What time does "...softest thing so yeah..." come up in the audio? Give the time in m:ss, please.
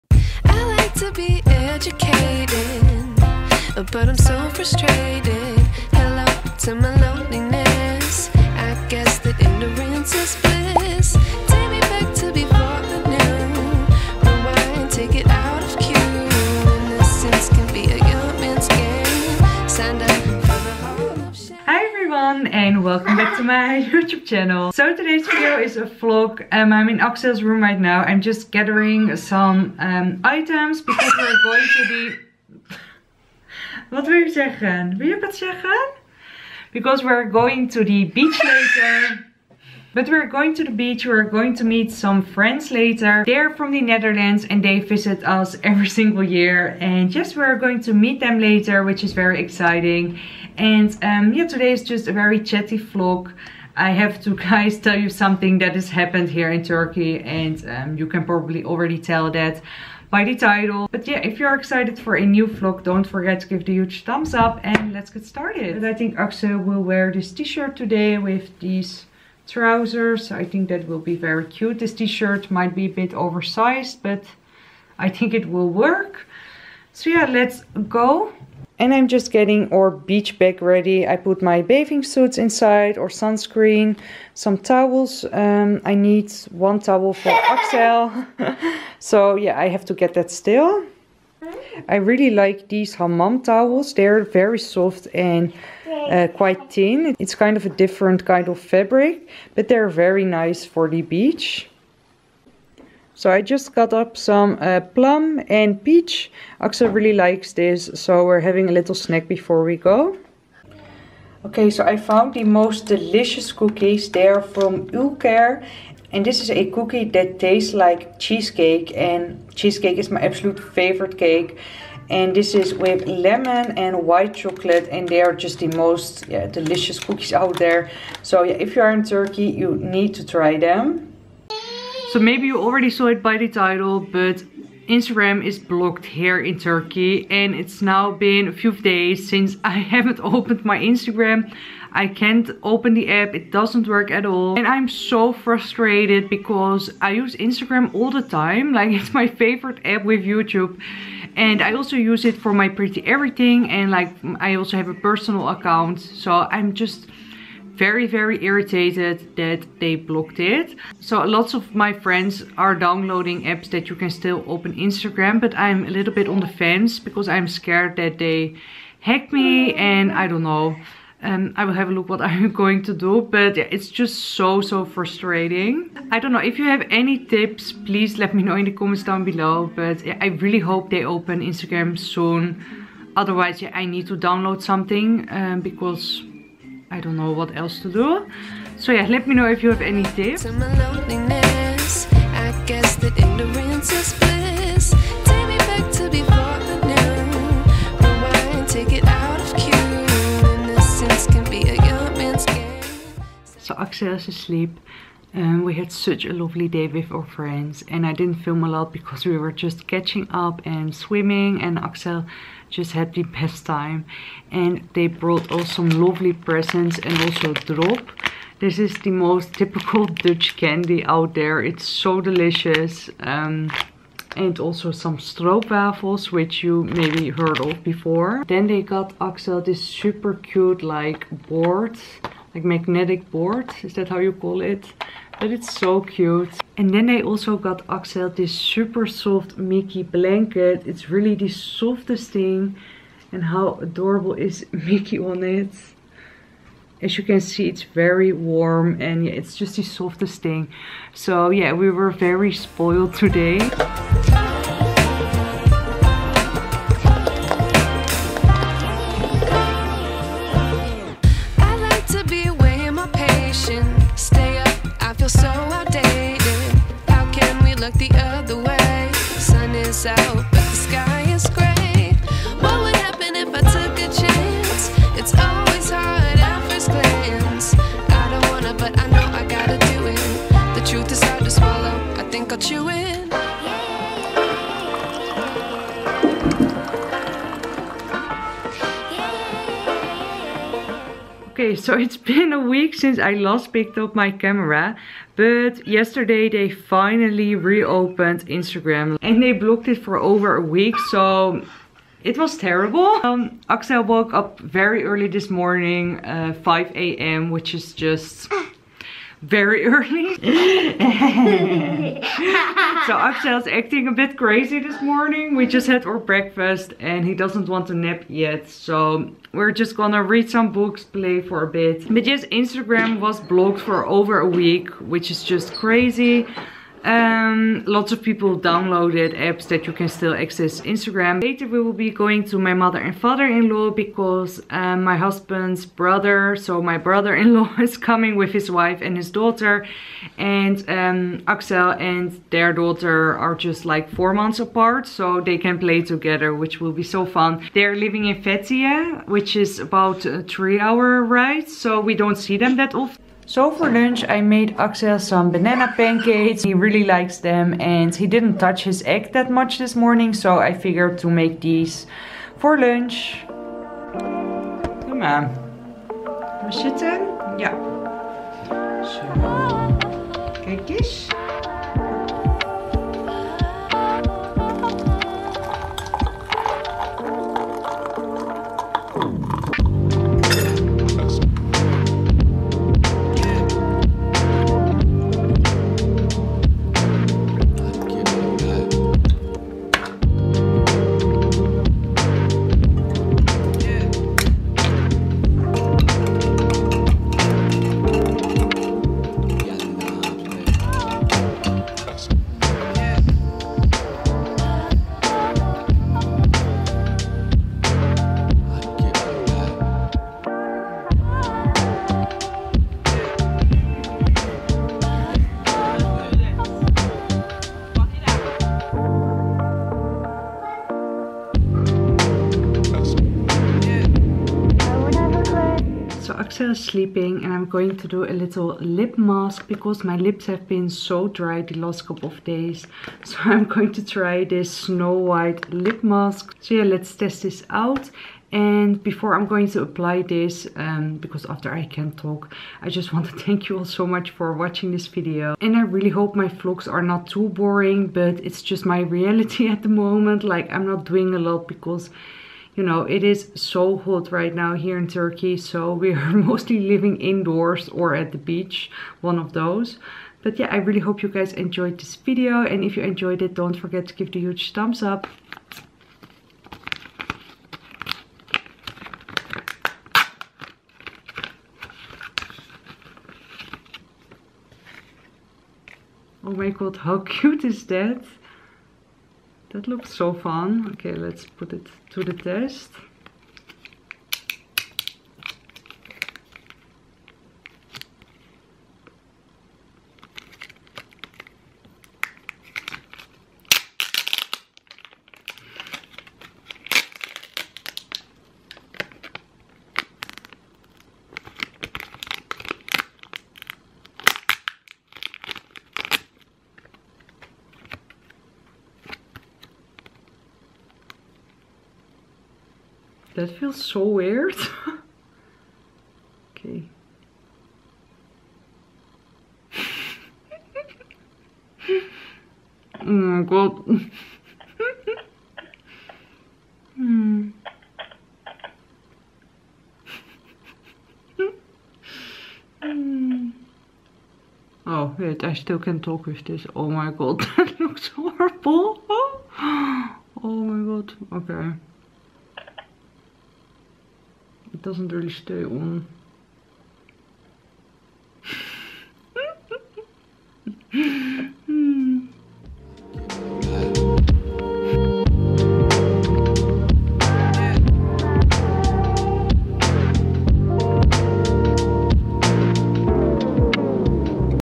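4:09.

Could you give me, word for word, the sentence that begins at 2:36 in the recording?
So I'm just very, very irritated that they blocked it.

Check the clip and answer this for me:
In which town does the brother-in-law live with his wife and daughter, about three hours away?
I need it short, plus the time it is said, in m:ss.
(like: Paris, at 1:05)
Fethiye, at 5:48.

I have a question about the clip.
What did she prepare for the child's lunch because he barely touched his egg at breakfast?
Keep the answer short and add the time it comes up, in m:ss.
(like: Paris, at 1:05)
Banana pancakes, at 5:55.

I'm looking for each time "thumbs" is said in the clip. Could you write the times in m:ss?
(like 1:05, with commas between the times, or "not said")
1:04, 7:44.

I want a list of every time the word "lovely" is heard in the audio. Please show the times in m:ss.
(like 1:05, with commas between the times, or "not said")
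3:26, 3:35.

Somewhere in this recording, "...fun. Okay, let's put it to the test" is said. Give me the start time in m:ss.
8:00.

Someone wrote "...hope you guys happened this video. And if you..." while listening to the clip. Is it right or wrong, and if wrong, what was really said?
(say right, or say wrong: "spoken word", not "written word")
wrong: "enjoyed", not "happened".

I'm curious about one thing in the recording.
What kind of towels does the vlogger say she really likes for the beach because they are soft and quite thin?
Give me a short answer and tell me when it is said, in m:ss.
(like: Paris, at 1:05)
Hammam towels, at 1:32.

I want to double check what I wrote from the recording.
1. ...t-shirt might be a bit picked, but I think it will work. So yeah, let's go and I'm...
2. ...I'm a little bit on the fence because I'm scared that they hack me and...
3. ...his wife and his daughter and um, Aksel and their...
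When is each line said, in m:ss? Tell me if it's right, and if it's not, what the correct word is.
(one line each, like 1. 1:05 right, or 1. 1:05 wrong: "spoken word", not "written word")
1. 1:11 wrong: "oversized", not "picked"
2. 2:45 right
3. 5:38 right.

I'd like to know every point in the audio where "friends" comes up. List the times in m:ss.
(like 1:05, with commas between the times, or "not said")
0:42, 2:41, 3:27.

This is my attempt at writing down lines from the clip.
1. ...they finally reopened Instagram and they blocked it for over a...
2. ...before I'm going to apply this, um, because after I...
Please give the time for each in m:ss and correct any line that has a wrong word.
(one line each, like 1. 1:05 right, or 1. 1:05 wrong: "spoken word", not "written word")
1. 4:56 right
2. 7:19 right.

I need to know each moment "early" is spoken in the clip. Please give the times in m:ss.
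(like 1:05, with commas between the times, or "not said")
5:05, 5:09.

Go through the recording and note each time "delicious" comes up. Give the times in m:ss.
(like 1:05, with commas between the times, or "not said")
1:52, 2:06, 3:42.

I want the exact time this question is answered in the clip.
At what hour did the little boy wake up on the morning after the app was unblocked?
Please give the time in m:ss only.
5:06.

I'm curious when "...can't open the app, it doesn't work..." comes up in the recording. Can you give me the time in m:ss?
2:22.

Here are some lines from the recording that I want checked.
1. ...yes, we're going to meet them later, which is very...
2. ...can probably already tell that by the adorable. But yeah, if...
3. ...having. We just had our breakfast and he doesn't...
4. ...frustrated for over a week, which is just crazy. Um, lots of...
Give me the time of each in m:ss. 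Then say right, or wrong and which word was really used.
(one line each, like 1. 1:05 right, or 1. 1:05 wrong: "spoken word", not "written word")
1. 0:47 right
2. 0:58 wrong: "title", not "adorable"
3. 5:15 wrong: "morning", not "having"
4. 5:23 wrong: "blocked", not "frustrated".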